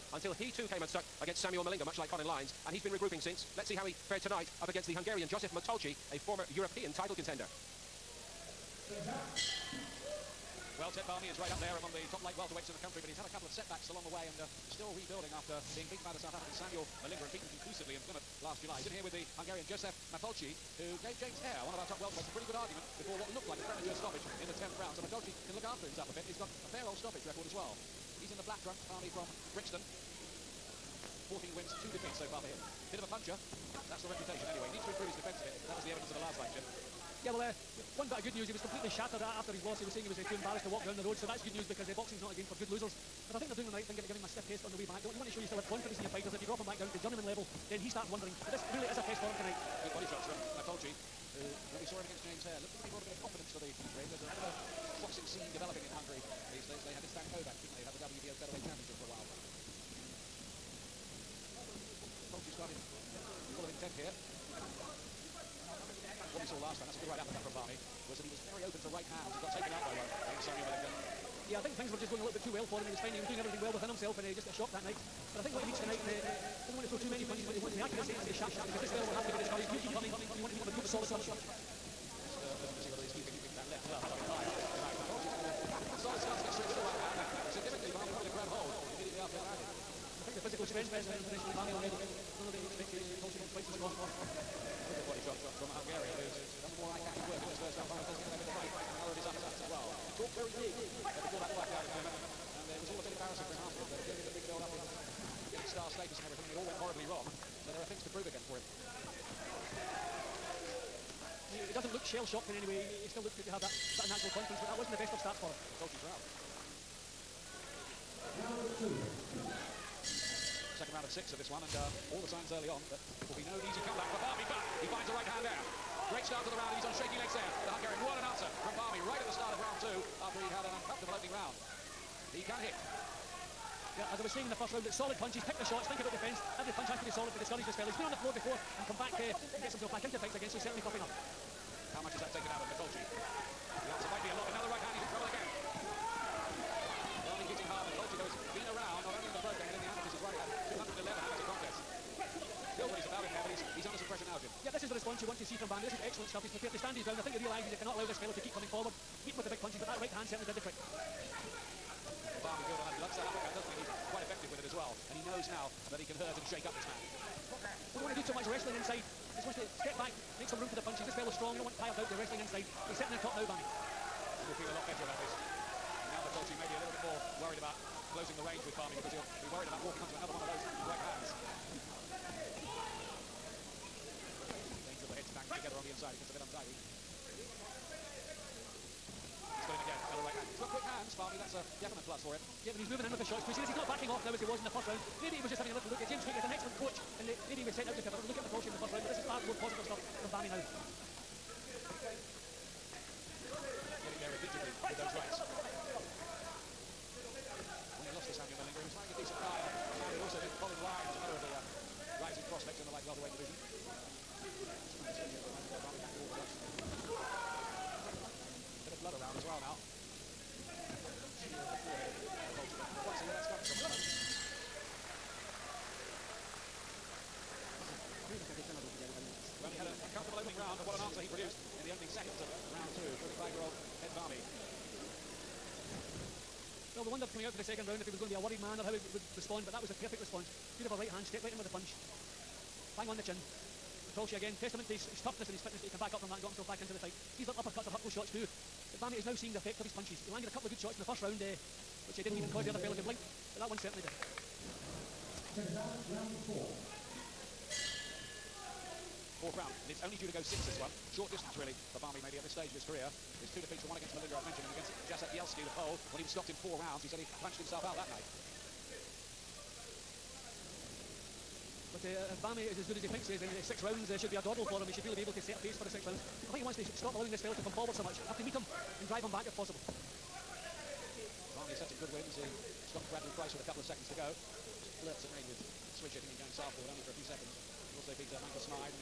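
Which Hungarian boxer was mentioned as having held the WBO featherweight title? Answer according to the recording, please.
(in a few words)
István Kovács.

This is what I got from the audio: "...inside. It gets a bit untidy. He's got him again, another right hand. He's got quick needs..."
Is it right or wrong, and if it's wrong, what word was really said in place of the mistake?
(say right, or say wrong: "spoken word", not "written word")
wrong: "hands", not "needs".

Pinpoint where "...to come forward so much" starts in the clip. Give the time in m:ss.
4:37.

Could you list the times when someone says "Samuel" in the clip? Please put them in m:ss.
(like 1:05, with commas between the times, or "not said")
0:01, 0:16, 1:10.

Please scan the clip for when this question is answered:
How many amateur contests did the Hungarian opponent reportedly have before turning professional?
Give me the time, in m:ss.
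2:30.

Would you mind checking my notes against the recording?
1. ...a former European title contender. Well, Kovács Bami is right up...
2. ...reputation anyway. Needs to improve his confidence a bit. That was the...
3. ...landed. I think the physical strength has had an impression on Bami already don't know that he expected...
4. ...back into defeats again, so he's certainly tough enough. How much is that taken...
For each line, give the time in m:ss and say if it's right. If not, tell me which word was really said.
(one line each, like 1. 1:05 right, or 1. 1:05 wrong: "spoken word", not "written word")
1. 0:06 wrong: "Ted", not "Kovács"
2. 0:34 wrong: "defence", not "confidence"
3. 1:29 right
4. 2:19 wrong: "fights", not "defeats".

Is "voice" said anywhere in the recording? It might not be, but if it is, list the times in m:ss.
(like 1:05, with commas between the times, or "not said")
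not said.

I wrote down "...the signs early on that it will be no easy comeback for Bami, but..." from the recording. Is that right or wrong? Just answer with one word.
right.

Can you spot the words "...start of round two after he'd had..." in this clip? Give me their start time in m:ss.
2:09.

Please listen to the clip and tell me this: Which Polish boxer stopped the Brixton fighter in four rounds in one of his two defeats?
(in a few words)
Jacek Bielski.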